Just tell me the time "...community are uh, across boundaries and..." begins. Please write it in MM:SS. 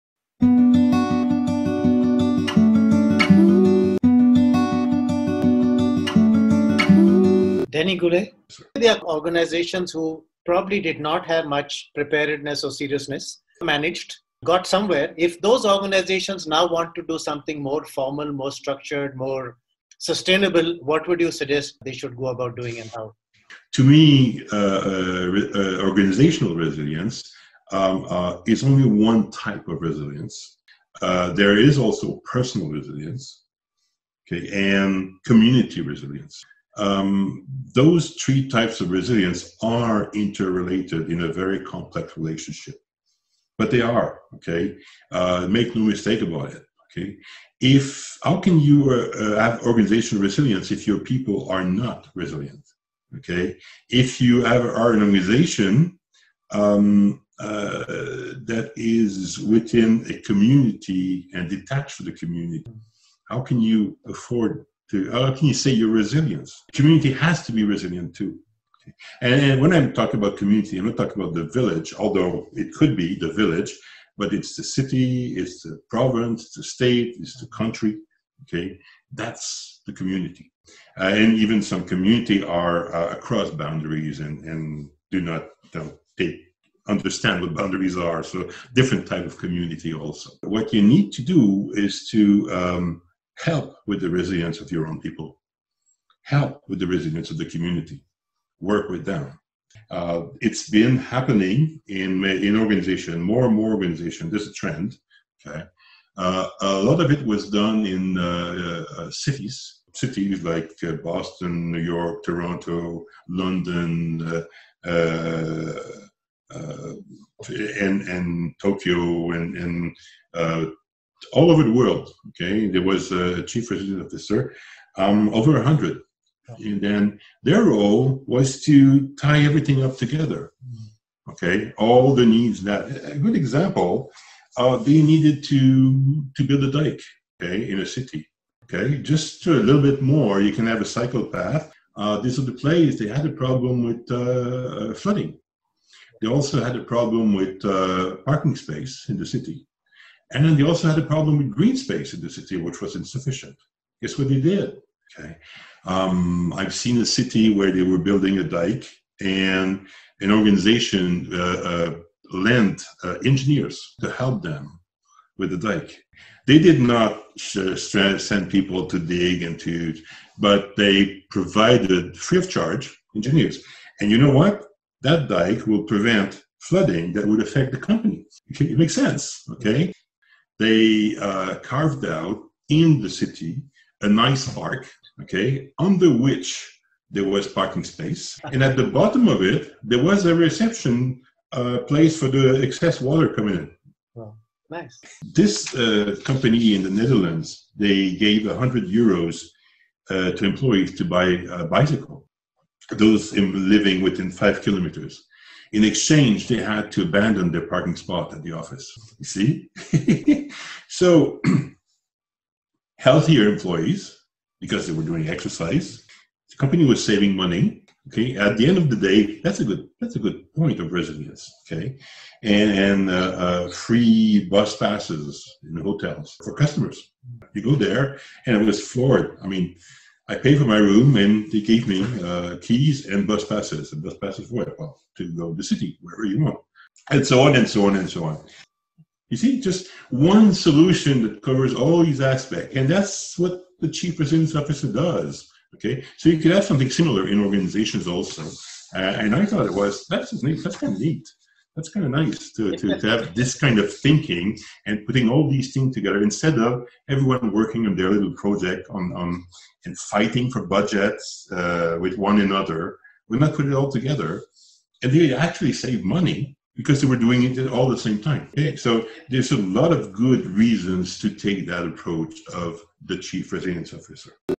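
01:21.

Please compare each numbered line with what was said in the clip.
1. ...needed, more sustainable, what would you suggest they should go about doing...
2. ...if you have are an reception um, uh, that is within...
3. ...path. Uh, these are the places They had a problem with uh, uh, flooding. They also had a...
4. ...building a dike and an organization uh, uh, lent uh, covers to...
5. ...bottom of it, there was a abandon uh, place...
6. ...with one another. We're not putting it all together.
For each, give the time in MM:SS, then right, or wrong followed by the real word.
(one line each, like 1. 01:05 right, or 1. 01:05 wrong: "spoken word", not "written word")
1. 00:18 wrong: "structured", not "needed"
2. 00:53 wrong: "organization", not "reception"
3. 02:21 right
4. 02:37 wrong: "engineers", not "covers"
5. 03:08 wrong: "reception", not "abandon"
6. 04:21 right.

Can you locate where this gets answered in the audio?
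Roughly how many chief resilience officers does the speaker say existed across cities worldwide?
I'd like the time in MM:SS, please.
02:05.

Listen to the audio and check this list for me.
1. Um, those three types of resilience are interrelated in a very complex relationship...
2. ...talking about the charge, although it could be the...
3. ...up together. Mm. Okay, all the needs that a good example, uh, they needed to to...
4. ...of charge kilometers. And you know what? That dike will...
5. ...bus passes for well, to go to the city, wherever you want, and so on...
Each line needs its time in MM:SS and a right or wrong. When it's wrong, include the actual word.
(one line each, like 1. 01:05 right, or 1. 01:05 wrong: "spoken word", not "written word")
1. 00:36 right
2. 01:10 wrong: "village", not "charge"
3. 02:09 right
4. 02:52 wrong: "engineers", not "kilometers"
5. 03:54 right.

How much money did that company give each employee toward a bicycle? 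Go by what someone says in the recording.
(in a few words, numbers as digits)
100 euros.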